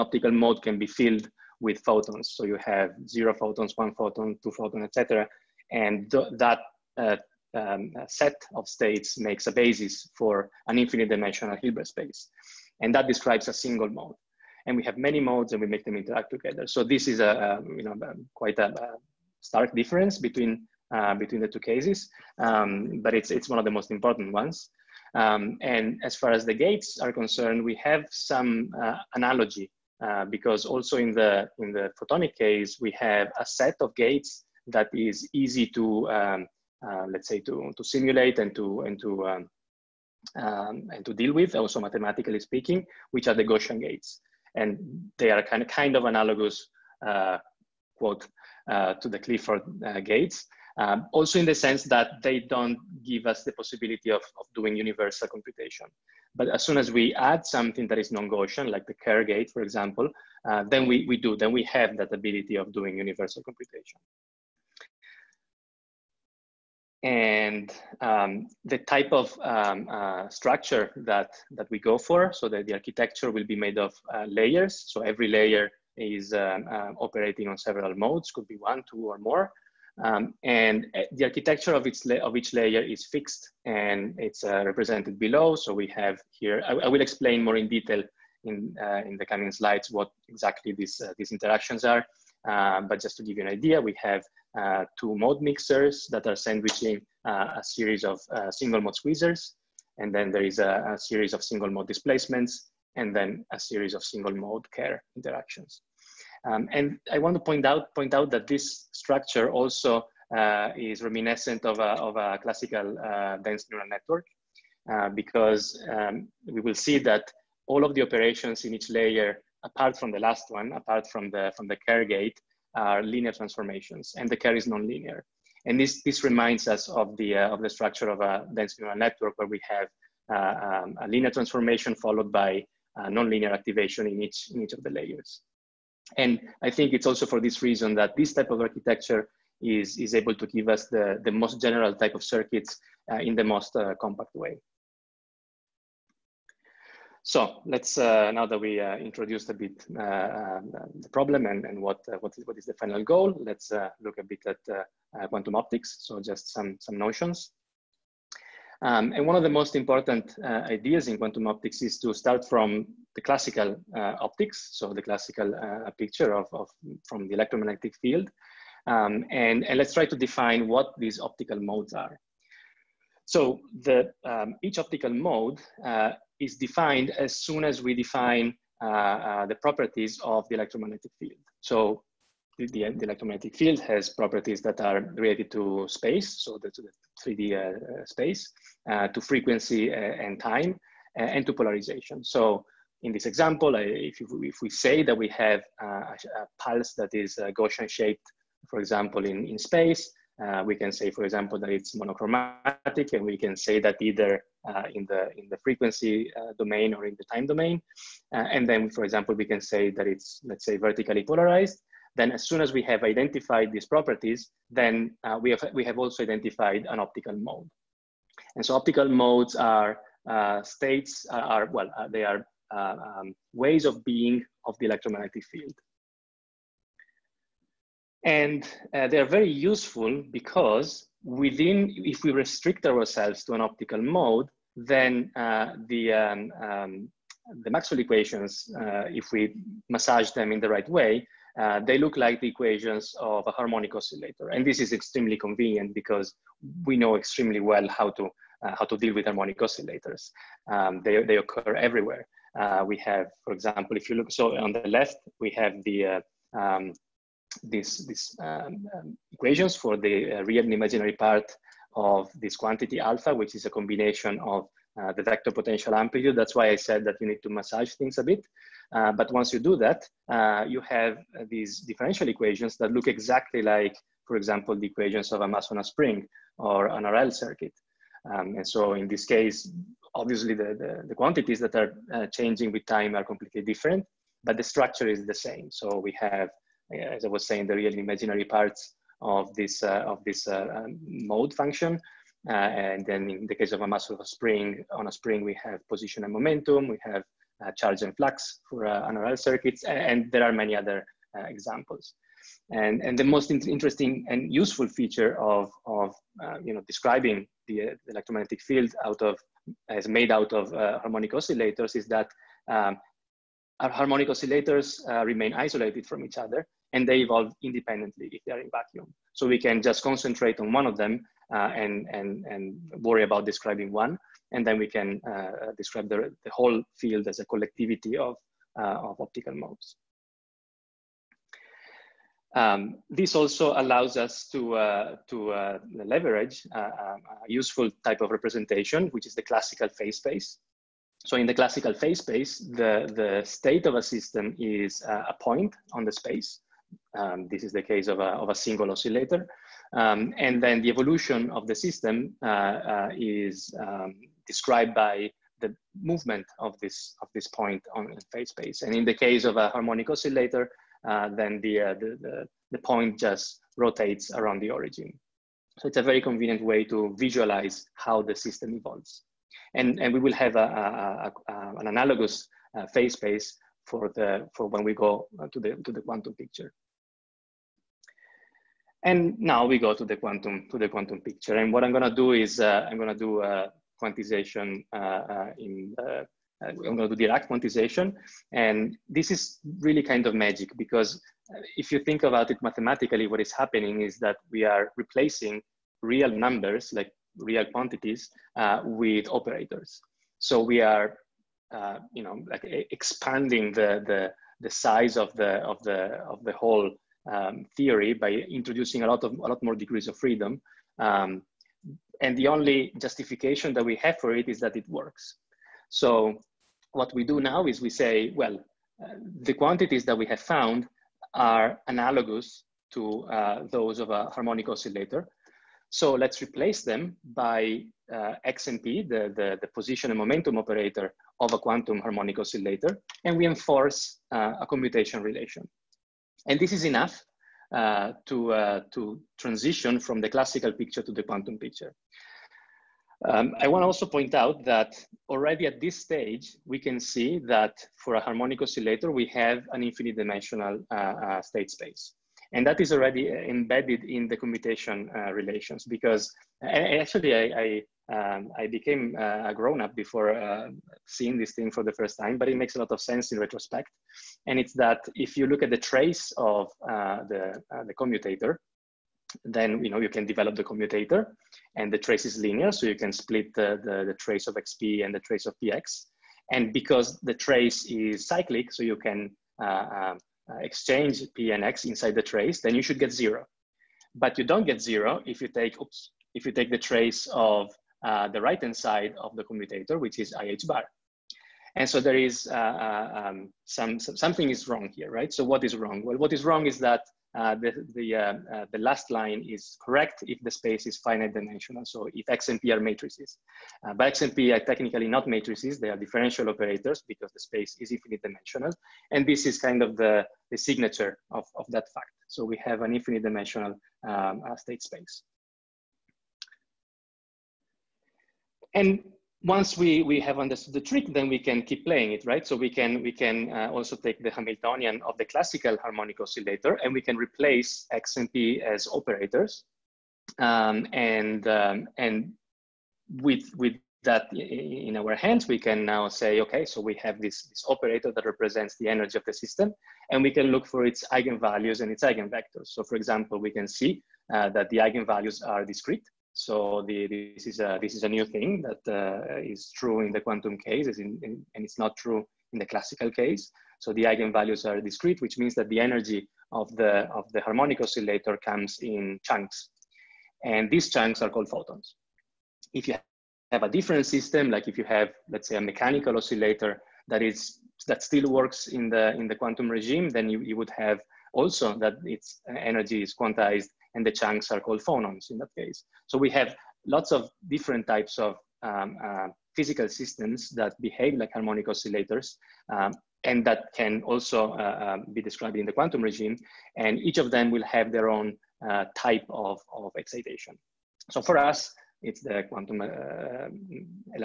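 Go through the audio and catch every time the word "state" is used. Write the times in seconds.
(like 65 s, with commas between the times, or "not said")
8 s, 220 s, 343 s, 451 s, 514 s.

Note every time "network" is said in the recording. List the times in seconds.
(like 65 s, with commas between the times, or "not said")
113 s, 128 s.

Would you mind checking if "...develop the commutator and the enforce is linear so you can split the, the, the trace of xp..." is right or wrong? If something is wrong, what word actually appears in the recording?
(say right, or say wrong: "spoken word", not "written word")
wrong: "trace", not "enforce".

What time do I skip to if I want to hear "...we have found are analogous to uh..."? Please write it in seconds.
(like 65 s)
420 s.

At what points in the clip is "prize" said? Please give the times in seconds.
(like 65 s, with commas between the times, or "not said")
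not said.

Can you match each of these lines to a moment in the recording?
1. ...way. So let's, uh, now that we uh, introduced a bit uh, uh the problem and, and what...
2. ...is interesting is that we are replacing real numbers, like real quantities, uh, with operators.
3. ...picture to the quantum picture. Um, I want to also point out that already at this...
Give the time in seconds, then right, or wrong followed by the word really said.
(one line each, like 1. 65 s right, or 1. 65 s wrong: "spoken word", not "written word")
1. 144 s right
2. 393 s wrong: "happening", not "interesting"
3. 440 s right.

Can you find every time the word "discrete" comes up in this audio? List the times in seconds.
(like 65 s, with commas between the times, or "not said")
545 s, 554 s.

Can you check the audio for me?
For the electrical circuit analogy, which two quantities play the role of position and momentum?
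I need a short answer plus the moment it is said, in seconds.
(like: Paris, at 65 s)
charge and flux, at 297 s.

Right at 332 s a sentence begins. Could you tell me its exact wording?
Um, this also allows us to, uh, to uh, leverage a useful type of representation, which is the classical phase space.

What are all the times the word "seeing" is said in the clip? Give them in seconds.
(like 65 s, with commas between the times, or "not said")
461 s.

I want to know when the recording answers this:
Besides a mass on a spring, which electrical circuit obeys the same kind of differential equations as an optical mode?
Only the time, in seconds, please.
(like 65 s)
277 s.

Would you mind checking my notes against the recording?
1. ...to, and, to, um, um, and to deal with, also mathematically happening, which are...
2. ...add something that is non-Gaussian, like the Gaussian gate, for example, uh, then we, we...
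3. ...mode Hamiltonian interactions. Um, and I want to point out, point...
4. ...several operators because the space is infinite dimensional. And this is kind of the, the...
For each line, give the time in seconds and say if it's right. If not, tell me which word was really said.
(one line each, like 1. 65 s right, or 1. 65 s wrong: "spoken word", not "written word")
1. 38 s wrong: "speaking", not "happening"
2. 57 s wrong: "Kerr", not "Gaussian"
3. 104 s wrong: "Kerr", not "Hamiltonian"
4. 505 s wrong: "differential", not "several".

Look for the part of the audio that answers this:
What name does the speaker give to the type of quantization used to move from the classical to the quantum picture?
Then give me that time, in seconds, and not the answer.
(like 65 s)
387 s.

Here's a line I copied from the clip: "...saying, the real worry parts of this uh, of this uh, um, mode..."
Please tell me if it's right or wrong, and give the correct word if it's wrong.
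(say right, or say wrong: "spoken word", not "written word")
wrong: "imaginary", not "worry".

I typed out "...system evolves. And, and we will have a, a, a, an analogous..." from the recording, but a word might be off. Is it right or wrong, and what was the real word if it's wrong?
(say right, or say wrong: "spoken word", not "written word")
right.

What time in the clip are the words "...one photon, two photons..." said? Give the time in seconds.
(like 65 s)
3 s.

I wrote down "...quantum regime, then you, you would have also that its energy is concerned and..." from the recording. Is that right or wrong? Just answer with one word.
wrong.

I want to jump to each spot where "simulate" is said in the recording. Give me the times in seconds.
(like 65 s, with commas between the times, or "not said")
37 s.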